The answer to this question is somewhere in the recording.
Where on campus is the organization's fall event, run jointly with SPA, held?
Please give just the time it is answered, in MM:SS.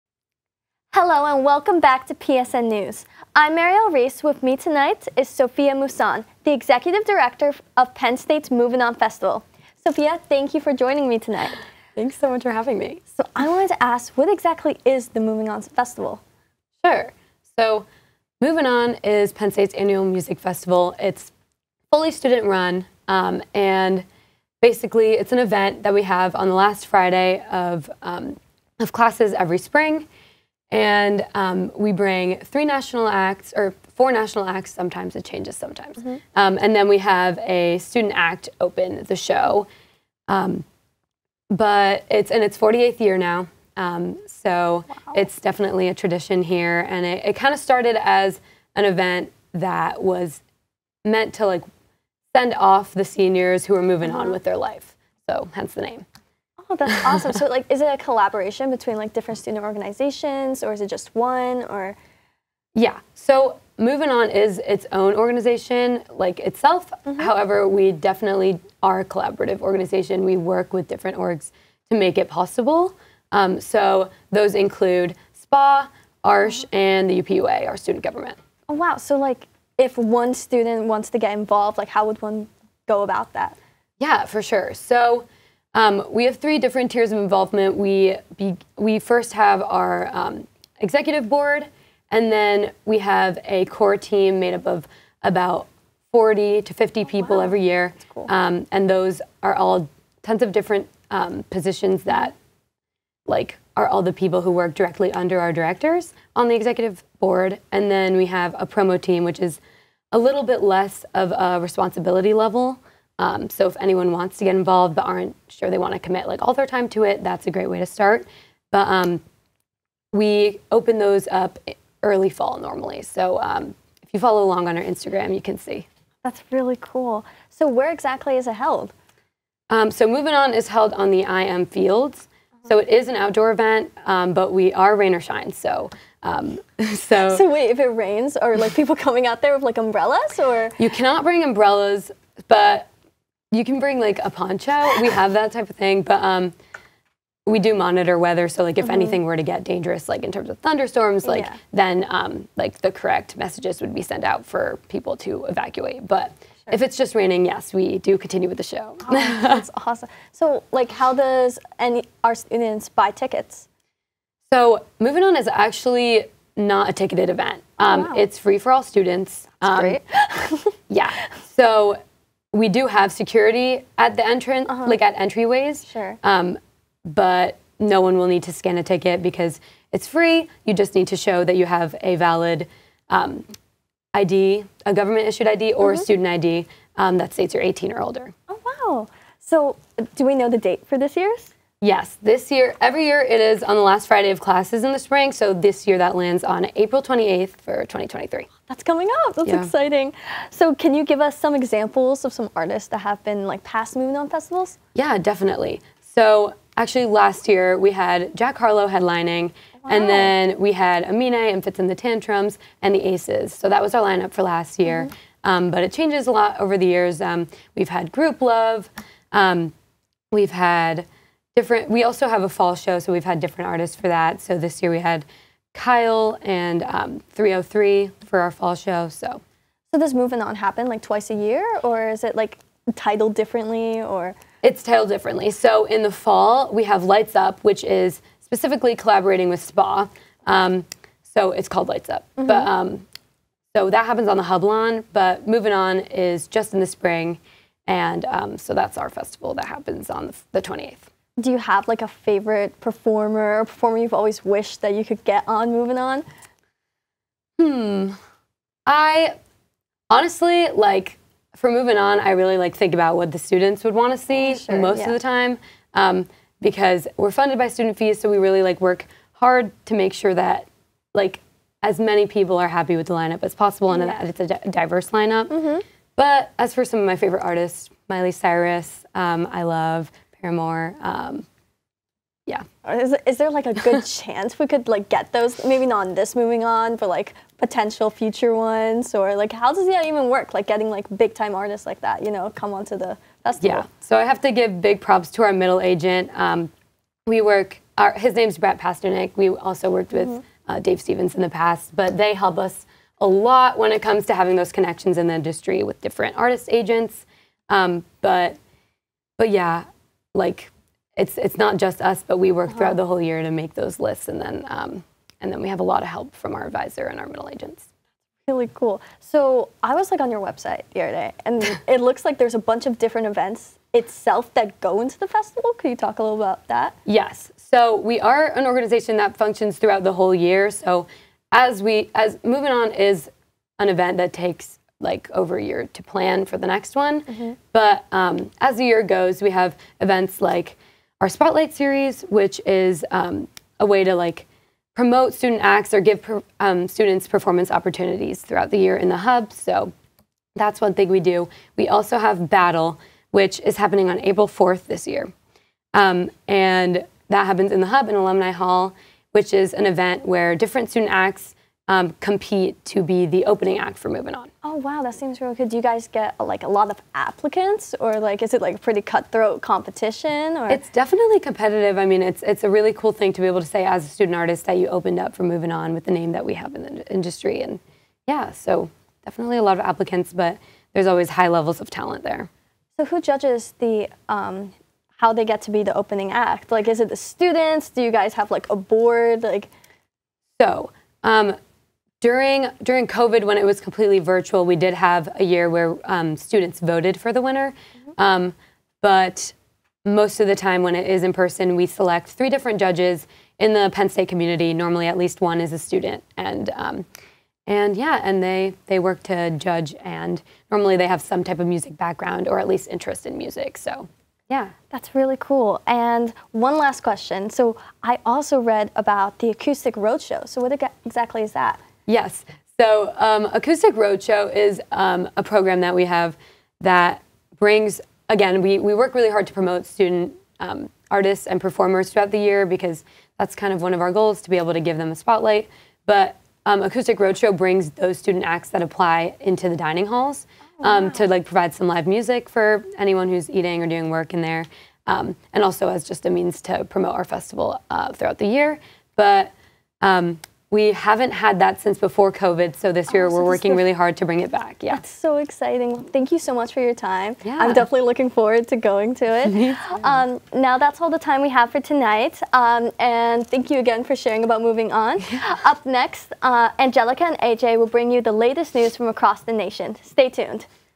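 04:04.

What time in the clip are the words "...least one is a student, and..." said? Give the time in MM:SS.
06:45.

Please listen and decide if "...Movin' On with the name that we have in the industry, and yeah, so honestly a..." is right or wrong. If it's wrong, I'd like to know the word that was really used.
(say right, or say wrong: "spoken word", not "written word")
wrong: "definitely", not "honestly".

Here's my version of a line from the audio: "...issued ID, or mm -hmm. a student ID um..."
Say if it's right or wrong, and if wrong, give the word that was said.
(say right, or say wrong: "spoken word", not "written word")
right.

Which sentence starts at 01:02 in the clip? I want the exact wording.
Yeah, so Movin' On is its own organization, like itself.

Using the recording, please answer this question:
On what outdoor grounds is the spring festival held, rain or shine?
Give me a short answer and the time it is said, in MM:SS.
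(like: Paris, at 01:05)
IM Fields, at 02:11.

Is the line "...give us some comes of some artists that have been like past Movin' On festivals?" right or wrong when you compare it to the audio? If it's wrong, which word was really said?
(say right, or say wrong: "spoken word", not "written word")
wrong: "examples", not "comes".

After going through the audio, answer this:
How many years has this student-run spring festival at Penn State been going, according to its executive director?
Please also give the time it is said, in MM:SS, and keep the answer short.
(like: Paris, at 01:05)
48th year, at 00:42.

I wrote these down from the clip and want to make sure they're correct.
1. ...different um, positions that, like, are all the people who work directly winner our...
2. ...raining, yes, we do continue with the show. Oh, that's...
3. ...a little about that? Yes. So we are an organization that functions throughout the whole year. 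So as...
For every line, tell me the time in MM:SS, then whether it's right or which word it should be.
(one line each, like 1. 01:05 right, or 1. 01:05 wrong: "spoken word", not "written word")
1. 01:40 wrong: "under", not "winner"
2. 02:37 right
3. 05:26 right.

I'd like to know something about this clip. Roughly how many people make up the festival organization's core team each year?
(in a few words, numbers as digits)
40 to 50.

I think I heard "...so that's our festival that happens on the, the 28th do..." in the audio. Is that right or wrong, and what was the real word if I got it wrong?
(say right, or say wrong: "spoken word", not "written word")
right.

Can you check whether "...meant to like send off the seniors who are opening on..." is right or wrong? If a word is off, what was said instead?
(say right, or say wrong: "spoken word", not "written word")
wrong: "moving", not "opening".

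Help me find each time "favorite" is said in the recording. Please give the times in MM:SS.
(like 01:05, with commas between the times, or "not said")
04:12, 04:37.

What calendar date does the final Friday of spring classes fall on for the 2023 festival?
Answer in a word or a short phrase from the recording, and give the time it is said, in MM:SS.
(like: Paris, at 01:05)
April 28th, at 03:16.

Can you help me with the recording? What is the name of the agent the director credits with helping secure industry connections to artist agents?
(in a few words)
Brett Pasternak.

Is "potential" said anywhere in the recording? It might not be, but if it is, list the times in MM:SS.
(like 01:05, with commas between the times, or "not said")
04:47.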